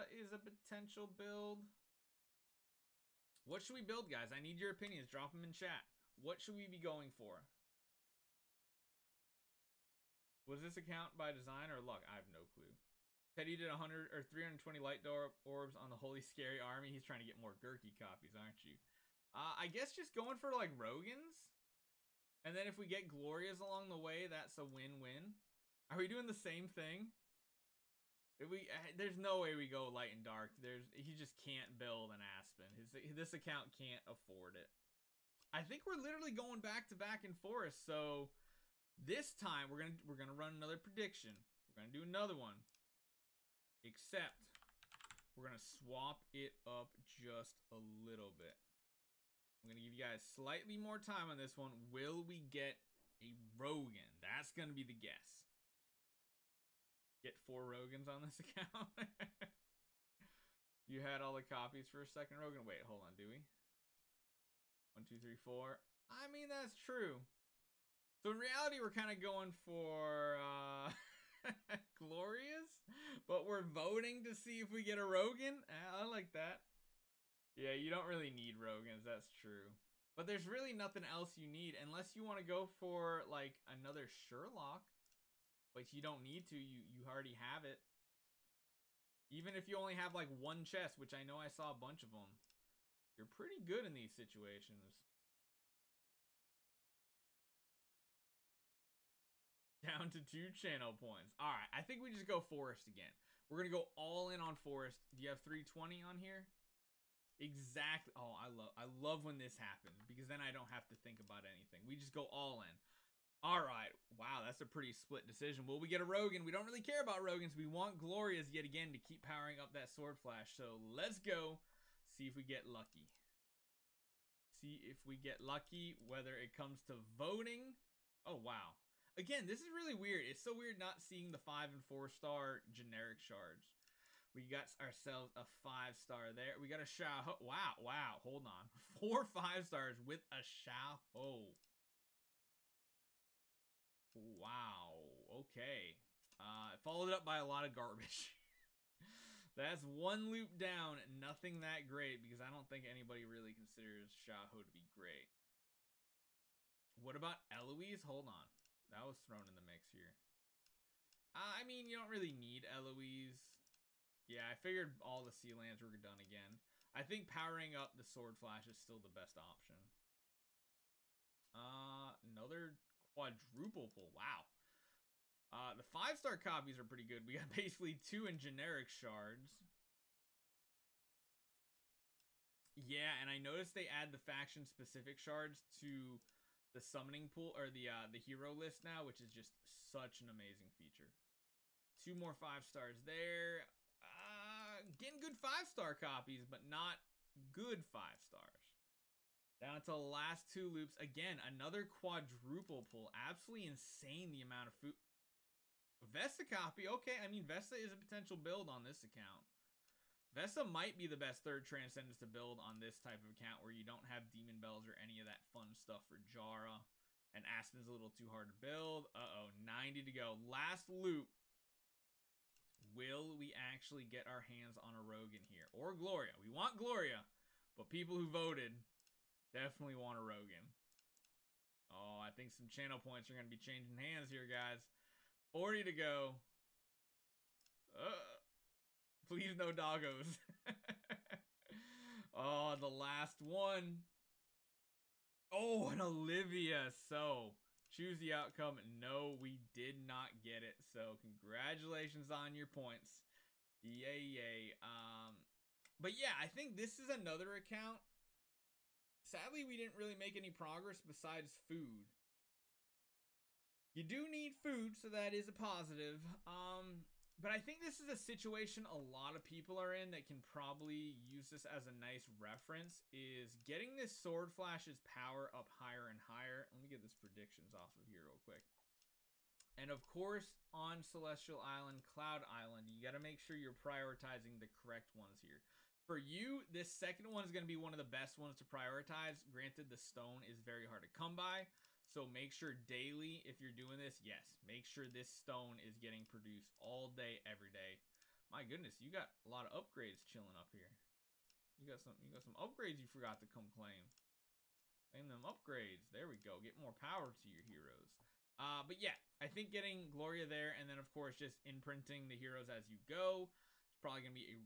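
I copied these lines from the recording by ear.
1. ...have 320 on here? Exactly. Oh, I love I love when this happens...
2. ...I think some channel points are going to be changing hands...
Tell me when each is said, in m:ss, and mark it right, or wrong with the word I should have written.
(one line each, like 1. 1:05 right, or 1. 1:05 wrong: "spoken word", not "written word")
1. 1:45 right
2. 3:52 right.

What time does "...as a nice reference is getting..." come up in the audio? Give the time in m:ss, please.
4:31.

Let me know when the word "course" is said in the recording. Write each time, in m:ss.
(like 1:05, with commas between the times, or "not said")
4:40, 5:11.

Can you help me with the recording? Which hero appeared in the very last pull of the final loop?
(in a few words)
Olivia.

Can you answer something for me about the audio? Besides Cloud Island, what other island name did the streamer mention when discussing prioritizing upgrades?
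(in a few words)
Celestial Island.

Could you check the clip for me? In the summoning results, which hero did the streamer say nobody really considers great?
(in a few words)
Shaho.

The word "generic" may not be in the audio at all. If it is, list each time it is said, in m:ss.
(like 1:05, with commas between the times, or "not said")
2:12, 2:58.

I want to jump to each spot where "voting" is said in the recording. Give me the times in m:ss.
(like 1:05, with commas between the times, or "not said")
1:13, 2:06.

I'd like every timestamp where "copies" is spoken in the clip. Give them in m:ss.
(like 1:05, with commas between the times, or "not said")
0:17, 1:01, 2:56, 3:15.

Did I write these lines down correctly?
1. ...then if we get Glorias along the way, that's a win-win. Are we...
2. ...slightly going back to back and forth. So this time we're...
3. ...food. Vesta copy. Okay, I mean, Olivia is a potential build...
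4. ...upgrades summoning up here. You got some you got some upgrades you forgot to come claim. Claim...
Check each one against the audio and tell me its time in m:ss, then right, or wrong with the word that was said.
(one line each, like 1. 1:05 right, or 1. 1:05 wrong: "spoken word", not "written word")
1. 0:22 right
2. 0:35 wrong: "literally", not "slightly"
3. 3:24 wrong: "Vesta", not "Olivia"
4. 4:59 wrong: "chilling", not "summoning".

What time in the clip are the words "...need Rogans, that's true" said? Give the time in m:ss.
1:18.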